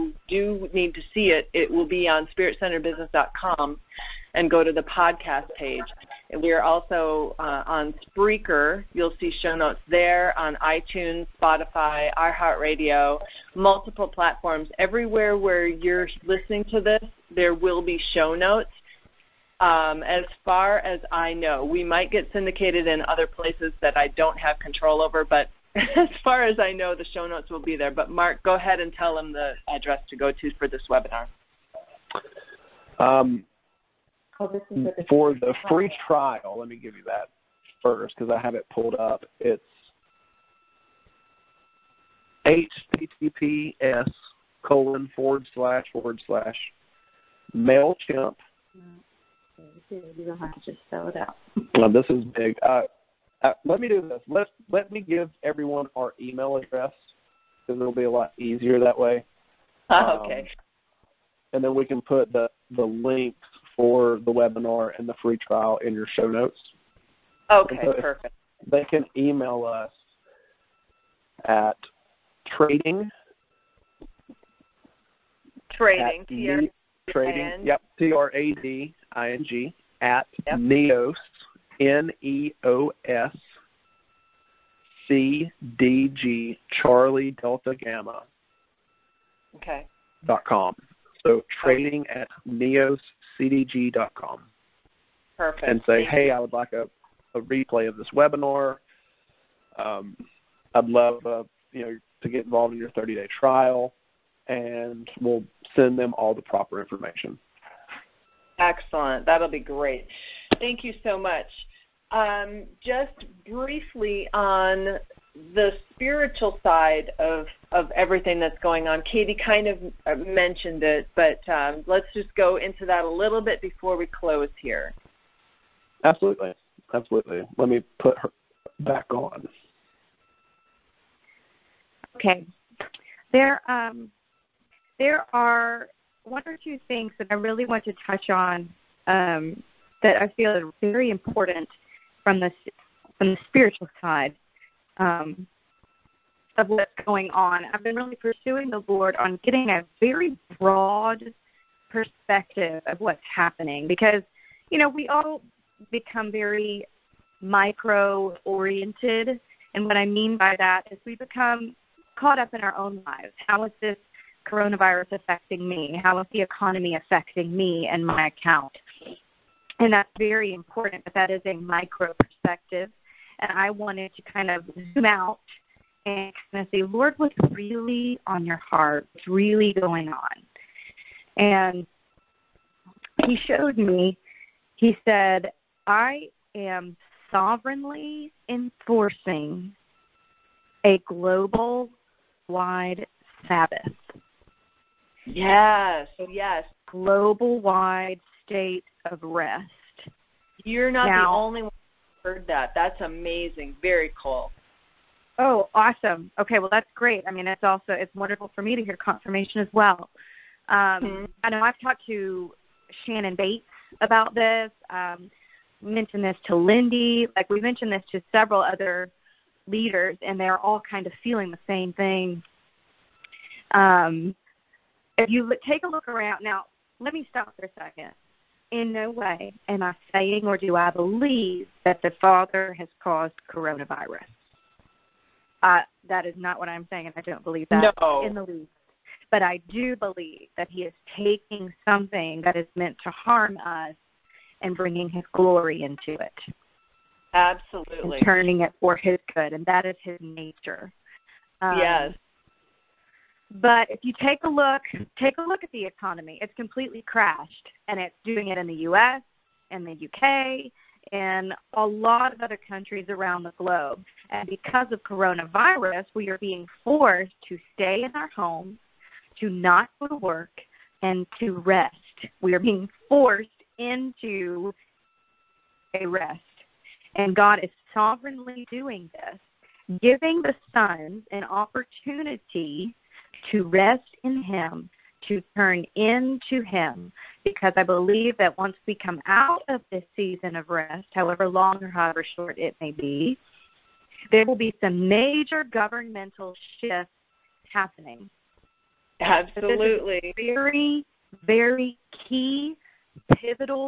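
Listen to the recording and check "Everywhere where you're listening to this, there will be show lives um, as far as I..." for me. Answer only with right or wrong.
wrong.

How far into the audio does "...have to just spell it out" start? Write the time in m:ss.
0:50.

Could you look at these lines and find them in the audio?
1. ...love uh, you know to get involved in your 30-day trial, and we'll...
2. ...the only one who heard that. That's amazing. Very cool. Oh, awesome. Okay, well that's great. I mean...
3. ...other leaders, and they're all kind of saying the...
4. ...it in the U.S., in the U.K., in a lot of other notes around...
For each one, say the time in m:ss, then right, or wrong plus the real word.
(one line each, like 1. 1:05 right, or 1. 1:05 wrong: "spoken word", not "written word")
1. 1:40 right
2. 3:21 right
3. 3:38 wrong: "feeling", not "saying"
4. 4:18 wrong: "countries", not "notes".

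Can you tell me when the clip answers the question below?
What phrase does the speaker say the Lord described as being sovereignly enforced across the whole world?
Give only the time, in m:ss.
3:11.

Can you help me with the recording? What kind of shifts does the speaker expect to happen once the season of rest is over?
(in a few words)
governmental shifts.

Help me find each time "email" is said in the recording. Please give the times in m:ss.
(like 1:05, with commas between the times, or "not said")
0:56, 1:09.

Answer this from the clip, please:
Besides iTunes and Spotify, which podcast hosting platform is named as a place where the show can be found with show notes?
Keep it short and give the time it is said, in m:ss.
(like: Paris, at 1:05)
Spreaker, at 0:08.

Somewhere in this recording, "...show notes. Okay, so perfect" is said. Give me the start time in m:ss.
1:06.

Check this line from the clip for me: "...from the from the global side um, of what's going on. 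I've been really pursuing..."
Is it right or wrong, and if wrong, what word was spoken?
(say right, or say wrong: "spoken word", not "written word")
wrong: "spiritual", not "global".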